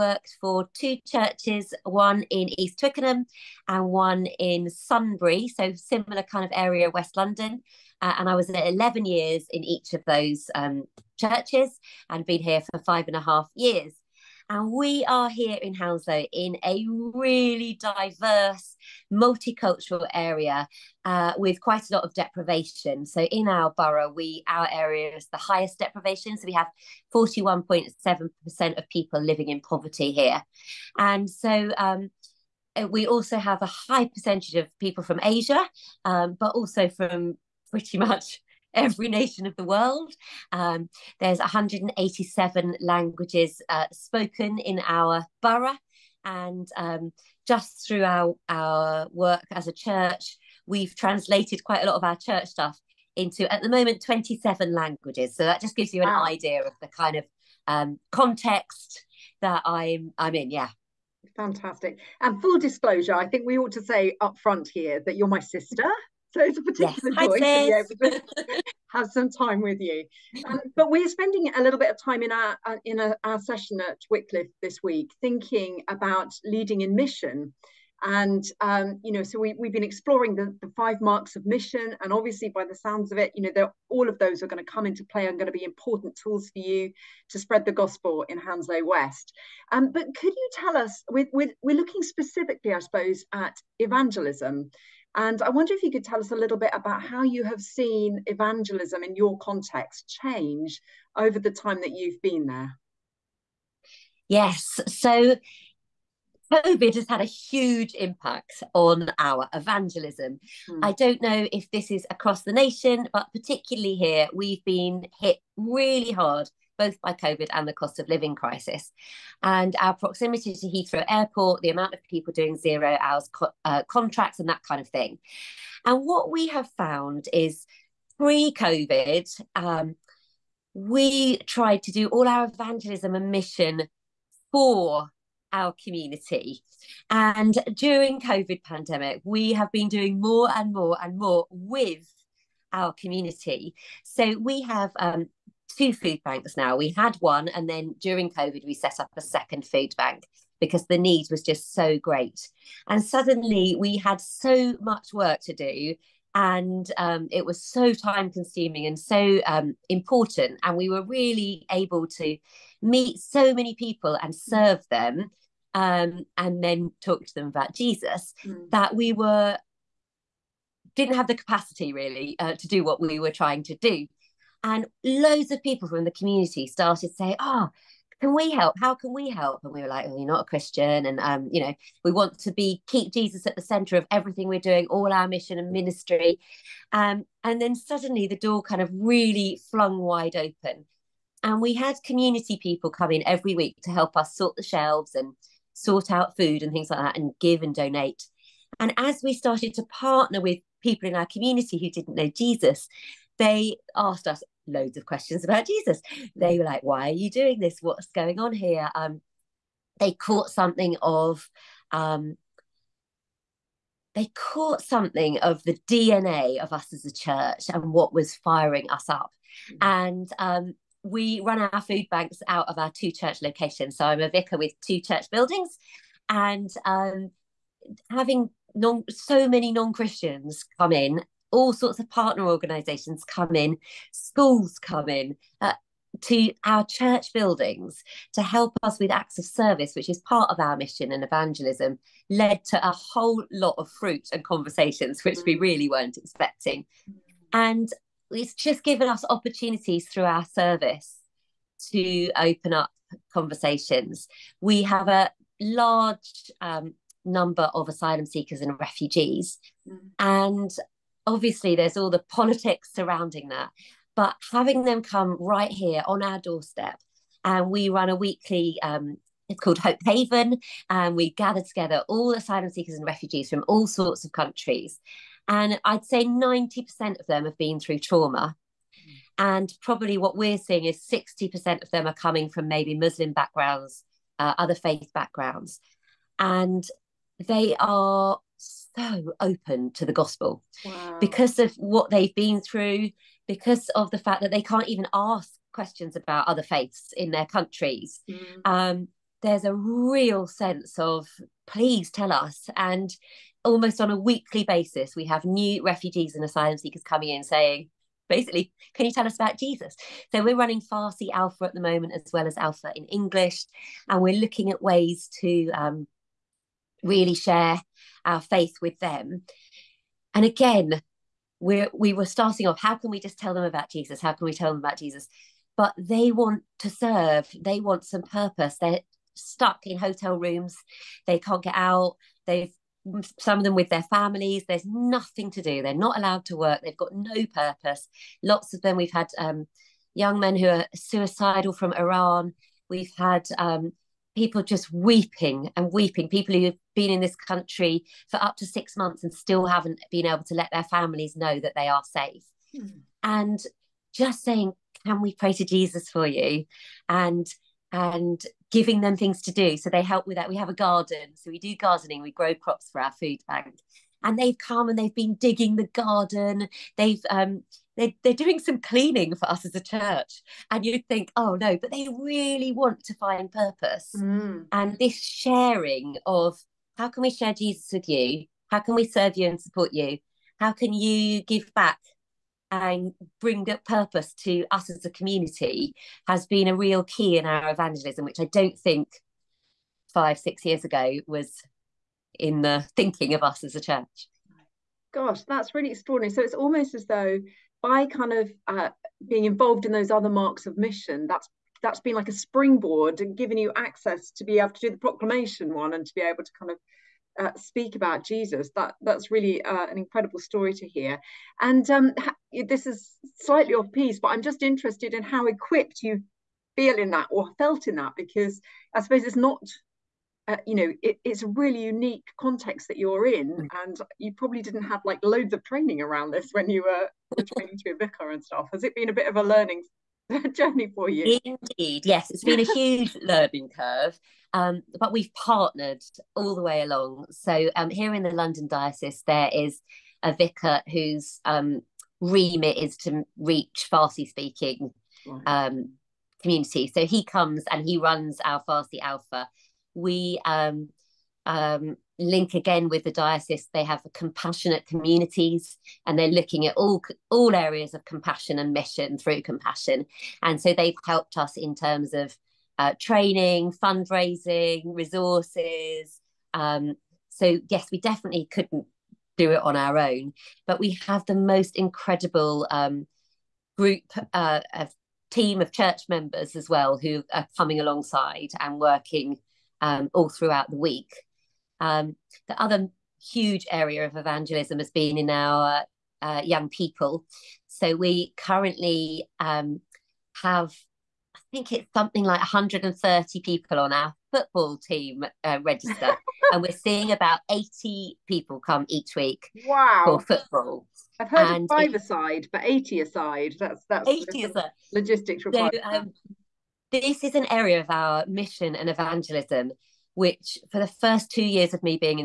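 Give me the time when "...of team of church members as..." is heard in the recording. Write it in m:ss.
7:54.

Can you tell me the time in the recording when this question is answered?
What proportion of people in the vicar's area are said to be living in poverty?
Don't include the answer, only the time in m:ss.
0:27.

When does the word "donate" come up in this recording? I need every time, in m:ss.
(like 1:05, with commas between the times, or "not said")
3:17.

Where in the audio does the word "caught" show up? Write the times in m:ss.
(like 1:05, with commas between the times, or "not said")
3:30, 3:34.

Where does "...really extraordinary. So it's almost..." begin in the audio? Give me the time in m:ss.
6:35.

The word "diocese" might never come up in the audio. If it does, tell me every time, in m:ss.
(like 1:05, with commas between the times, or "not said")
7:18, 7:33.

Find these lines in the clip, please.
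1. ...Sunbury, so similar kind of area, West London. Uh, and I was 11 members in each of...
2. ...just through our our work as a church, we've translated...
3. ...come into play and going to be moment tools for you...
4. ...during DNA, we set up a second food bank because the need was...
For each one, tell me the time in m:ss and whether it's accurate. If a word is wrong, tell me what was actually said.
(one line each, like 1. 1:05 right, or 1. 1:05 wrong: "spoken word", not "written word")
1. 0:04 wrong: "years", not "members"
2. 0:47 right
3. 1:24 wrong: "important", not "moment"
4. 2:28 wrong: "COVID", not "DNA".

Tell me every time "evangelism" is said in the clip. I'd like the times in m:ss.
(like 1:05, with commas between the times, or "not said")
1:33, 1:38, 1:49, 2:12, 4:01, 6:27, 8:04, 8:28.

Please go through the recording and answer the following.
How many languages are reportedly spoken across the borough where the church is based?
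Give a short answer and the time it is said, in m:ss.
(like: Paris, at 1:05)
187, at 0:41.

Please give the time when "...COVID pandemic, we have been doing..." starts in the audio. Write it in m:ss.
2:18.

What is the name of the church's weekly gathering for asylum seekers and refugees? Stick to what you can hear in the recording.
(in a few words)
Hope Haven.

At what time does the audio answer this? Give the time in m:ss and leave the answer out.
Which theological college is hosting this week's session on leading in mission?
1:14.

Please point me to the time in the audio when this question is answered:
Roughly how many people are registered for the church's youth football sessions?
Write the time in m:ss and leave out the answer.
8:12.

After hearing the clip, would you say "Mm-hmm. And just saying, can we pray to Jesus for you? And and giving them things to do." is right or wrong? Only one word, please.
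right.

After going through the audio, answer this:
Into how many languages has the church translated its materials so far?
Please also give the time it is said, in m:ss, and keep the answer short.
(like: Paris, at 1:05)
27, at 0:54.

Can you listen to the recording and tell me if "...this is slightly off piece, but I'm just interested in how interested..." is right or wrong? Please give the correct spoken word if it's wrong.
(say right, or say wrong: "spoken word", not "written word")
wrong: "equipped", not "interested".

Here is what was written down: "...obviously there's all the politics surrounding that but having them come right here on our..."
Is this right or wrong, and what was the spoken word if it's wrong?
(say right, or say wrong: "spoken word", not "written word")
right.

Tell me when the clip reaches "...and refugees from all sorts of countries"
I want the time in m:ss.
4:32.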